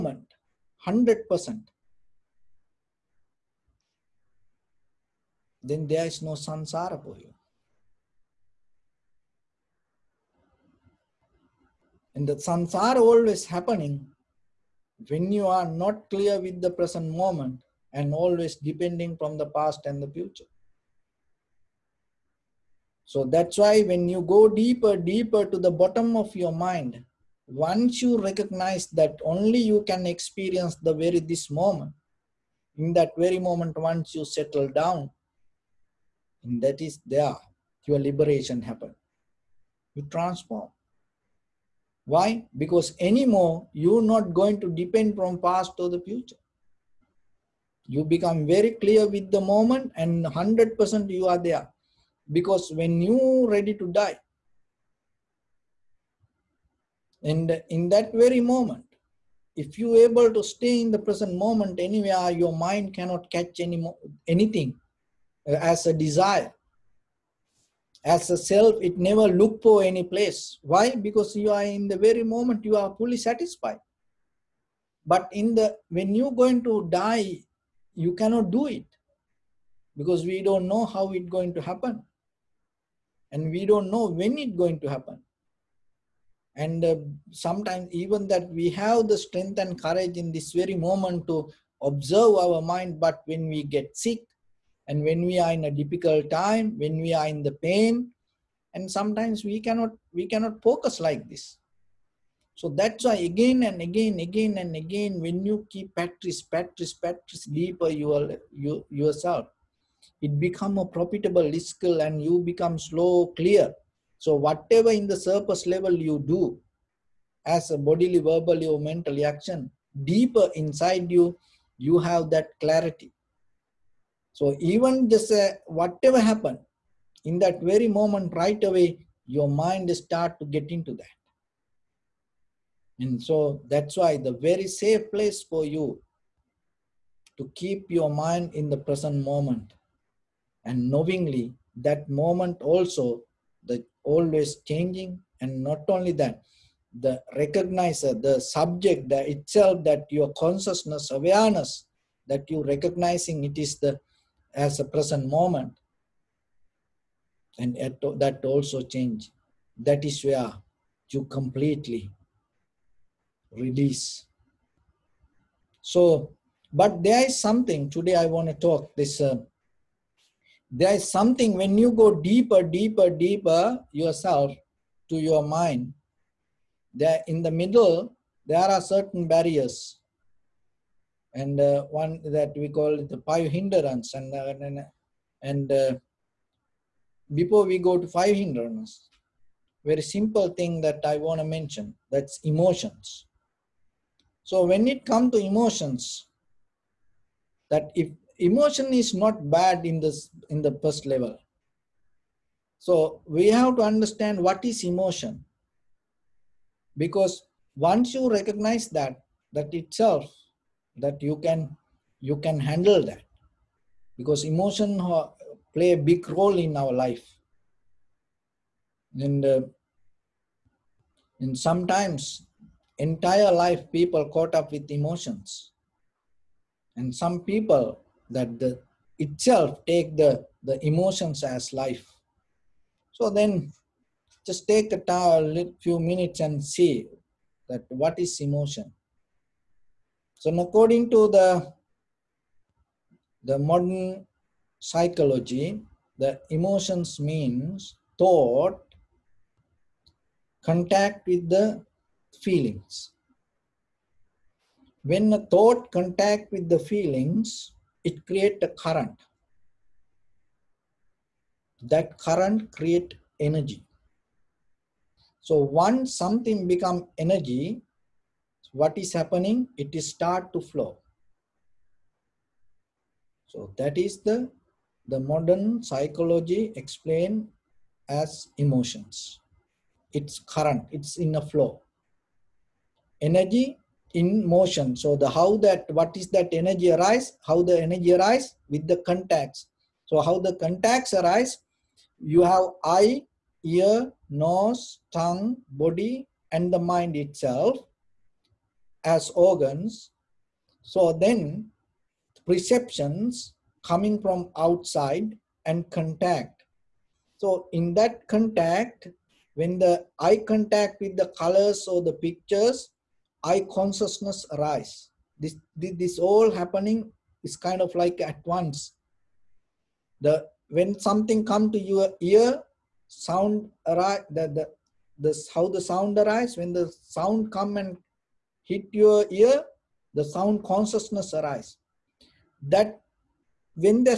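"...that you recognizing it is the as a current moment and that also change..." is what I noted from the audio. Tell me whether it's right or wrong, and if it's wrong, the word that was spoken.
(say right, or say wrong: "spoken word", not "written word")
wrong: "present", not "current".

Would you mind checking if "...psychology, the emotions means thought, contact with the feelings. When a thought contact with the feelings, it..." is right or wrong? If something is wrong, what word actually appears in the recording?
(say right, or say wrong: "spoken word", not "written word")
right.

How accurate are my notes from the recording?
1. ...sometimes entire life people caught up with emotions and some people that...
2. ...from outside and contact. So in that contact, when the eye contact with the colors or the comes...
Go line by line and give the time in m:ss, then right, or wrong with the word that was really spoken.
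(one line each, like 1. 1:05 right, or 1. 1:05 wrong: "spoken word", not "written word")
1. 3:41 right
2. 5:04 wrong: "pictures", not "comes".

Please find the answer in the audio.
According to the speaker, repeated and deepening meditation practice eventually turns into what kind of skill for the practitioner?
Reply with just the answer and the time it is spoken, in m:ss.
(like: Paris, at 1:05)
profitable skill, at 1:50.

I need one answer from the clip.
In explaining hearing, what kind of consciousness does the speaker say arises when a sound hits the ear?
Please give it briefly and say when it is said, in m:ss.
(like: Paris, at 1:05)
sound consciousness, at 5:30.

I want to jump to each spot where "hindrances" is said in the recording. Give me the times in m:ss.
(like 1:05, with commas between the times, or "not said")
3:03, 3:08.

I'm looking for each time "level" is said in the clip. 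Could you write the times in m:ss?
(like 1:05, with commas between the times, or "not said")
1:55, 3:21.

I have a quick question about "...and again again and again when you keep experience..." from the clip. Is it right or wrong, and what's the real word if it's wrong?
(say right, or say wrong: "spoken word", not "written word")
wrong: "practice", not "experience".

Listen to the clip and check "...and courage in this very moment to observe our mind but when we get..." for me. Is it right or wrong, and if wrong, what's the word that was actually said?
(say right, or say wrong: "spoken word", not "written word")
right.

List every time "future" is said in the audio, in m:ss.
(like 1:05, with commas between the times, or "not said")
0:20, 0:46.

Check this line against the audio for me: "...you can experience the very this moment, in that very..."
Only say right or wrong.
right.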